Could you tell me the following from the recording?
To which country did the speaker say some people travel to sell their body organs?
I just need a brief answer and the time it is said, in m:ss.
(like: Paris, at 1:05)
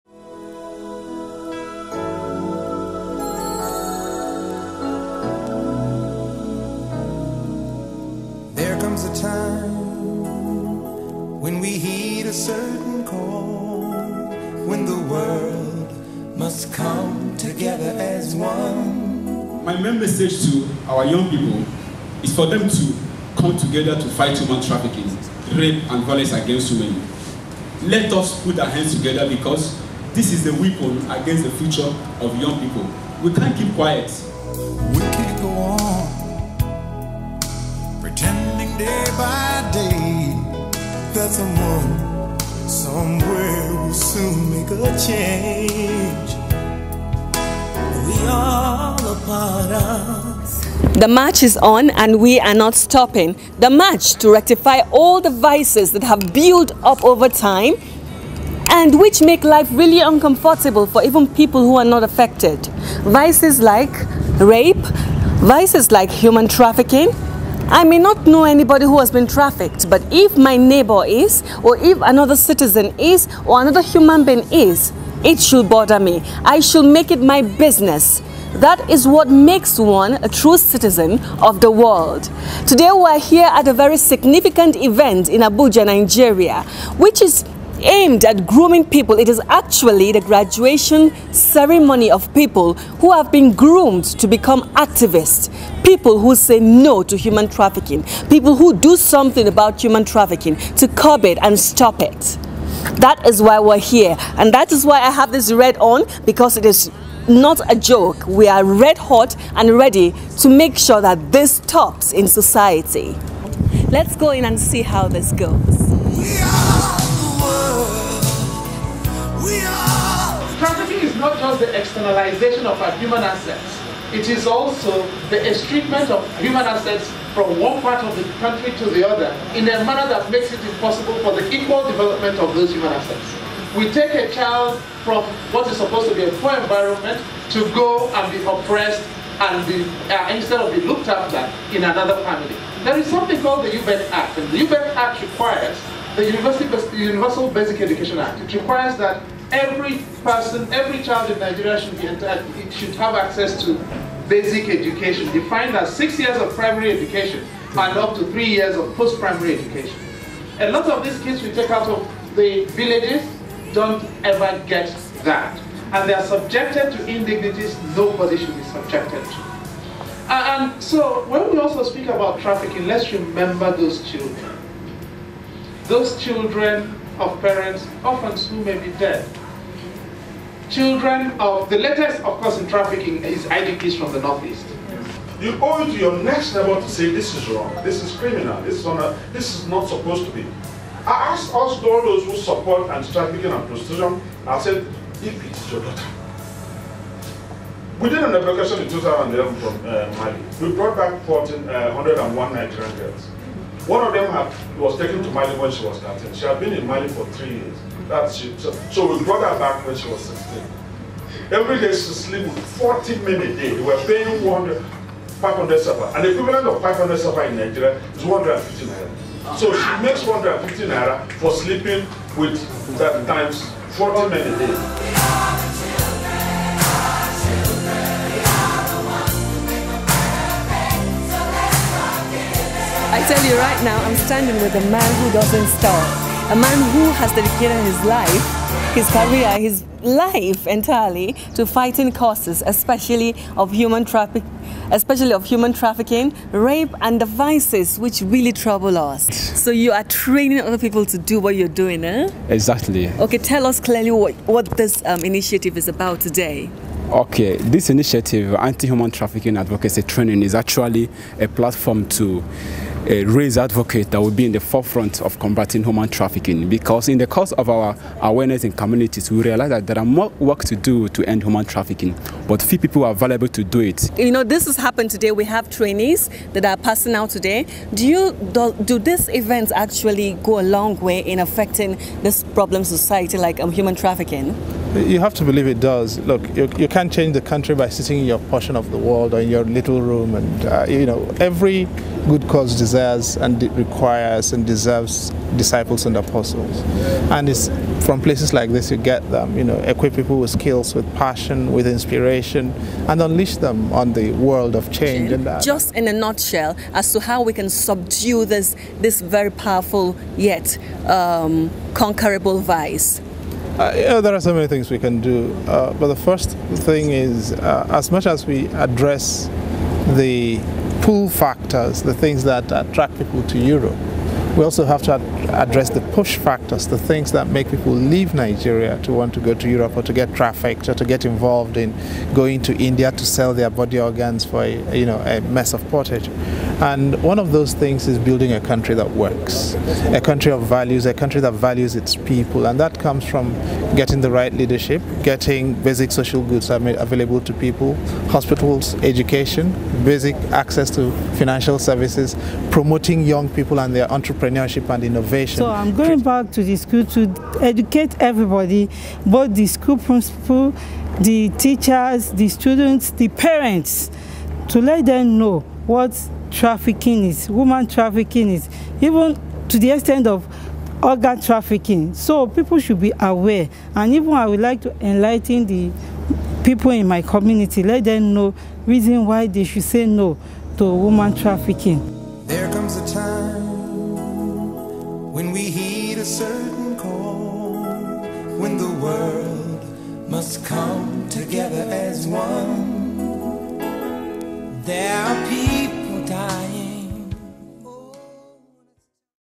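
India, at 5:32.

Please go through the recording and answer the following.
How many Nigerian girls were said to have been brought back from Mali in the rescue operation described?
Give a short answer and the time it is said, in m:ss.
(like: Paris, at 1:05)
1,401, at 3:21.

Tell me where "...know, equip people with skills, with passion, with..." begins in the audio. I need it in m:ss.
4:59.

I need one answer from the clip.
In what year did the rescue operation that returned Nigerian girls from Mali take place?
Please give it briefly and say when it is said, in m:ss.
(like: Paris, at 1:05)
2011, at 3:18.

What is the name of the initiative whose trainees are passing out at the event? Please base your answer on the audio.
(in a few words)
Anti-Human Trafficking Advocacy Training.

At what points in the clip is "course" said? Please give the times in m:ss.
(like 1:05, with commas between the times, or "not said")
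3:02, 4:27.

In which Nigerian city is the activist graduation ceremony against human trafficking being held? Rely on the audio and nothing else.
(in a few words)
Abuja.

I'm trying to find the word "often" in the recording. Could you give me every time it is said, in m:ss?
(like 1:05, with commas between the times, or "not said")
2:58.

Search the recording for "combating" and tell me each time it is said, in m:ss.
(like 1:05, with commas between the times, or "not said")
4:25.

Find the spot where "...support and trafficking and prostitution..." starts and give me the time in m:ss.
3:12.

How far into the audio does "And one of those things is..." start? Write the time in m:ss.
5:36.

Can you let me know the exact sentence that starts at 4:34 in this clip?
You know, this has happened today.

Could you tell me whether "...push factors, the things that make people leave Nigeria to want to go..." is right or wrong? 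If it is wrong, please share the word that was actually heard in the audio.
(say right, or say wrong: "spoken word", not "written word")
right.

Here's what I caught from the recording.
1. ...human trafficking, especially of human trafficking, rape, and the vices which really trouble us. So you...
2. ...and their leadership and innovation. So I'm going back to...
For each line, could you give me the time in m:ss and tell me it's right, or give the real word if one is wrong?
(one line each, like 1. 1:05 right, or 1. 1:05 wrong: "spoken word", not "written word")
1. 4:03 right
2. 5:53 wrong: "entrepreneurship", not "leadership".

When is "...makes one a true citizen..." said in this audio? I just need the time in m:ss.
1:19.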